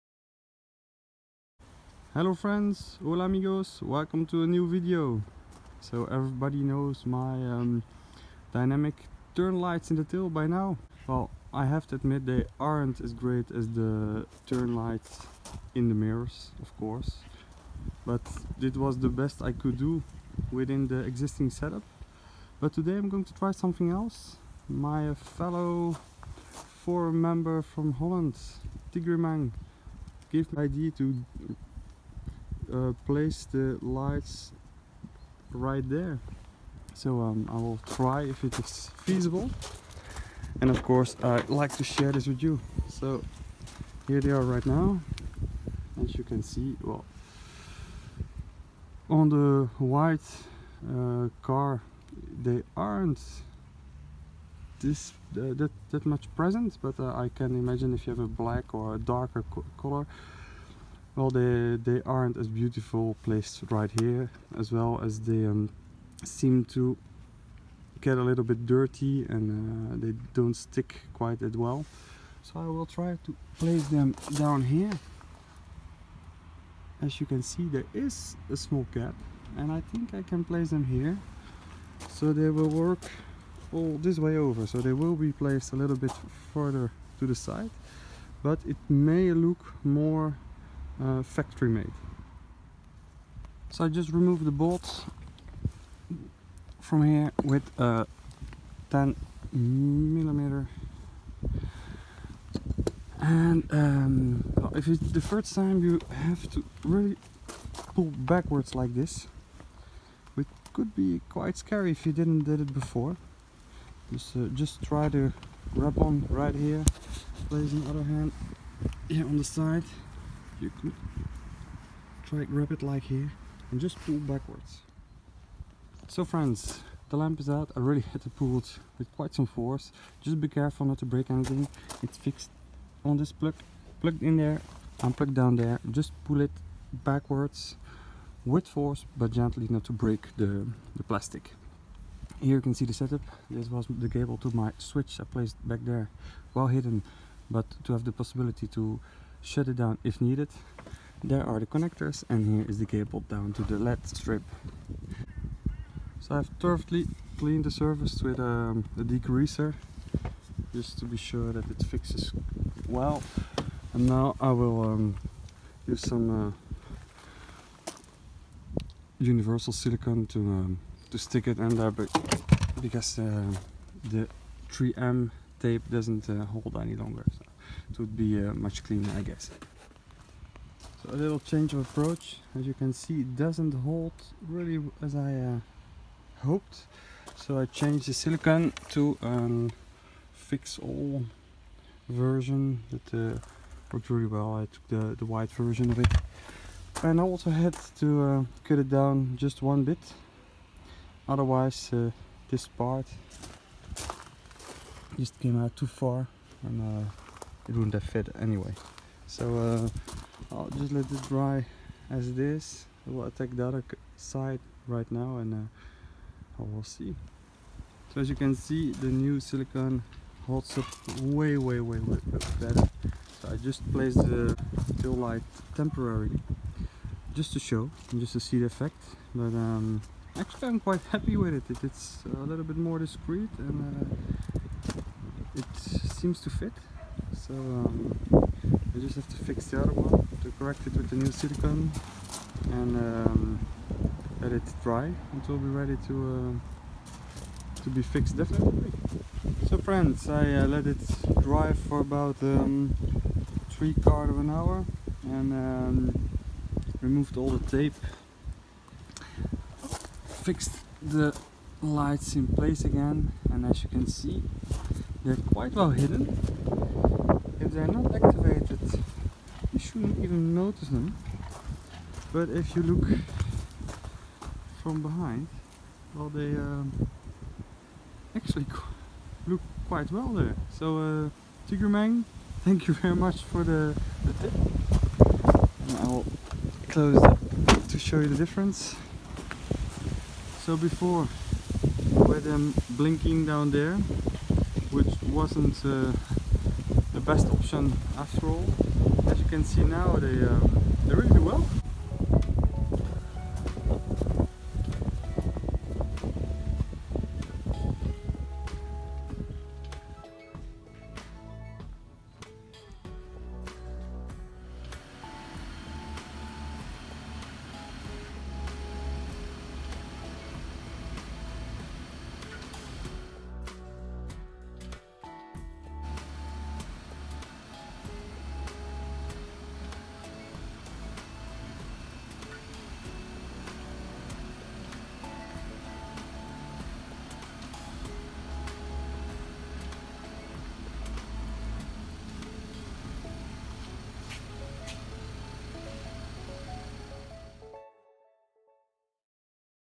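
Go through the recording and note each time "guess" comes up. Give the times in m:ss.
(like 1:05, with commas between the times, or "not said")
2:59.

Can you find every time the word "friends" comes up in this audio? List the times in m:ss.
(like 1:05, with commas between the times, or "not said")
0:02, 2:06, 4:09.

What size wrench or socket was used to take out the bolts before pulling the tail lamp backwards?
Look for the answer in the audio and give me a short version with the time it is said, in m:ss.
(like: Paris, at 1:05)
10 millimeter, at 1:38.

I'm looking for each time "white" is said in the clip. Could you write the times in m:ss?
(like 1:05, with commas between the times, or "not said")
0:49, 3:15.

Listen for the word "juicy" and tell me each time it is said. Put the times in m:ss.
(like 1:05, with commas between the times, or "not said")
not said.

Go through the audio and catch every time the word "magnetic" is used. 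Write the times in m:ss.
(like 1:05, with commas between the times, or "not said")
not said.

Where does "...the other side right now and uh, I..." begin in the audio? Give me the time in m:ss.
3:33.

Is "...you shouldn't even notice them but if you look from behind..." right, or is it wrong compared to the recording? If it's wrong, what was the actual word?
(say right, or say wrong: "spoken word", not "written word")
right.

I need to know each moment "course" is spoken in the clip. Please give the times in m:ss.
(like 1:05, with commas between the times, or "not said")
0:16, 0:40.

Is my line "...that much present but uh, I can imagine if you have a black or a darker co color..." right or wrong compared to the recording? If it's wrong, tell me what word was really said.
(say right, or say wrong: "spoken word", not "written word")
right.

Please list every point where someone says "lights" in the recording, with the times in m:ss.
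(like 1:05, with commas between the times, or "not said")
0:09, 0:14, 0:33, 3:45, 4:21.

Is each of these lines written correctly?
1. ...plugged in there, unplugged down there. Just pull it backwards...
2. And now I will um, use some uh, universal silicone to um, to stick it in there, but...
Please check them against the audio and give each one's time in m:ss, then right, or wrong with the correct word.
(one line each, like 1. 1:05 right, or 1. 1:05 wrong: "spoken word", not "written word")
1. 2:14 right
2. 2:43 right.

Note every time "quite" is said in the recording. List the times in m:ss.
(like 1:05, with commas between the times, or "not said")
1:11, 1:51, 2:09, 3:50, 4:25, 4:39.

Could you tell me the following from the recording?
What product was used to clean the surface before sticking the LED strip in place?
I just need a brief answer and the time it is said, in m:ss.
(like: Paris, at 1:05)
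degreaser, at 2:39.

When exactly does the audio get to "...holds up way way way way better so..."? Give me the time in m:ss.
3:40.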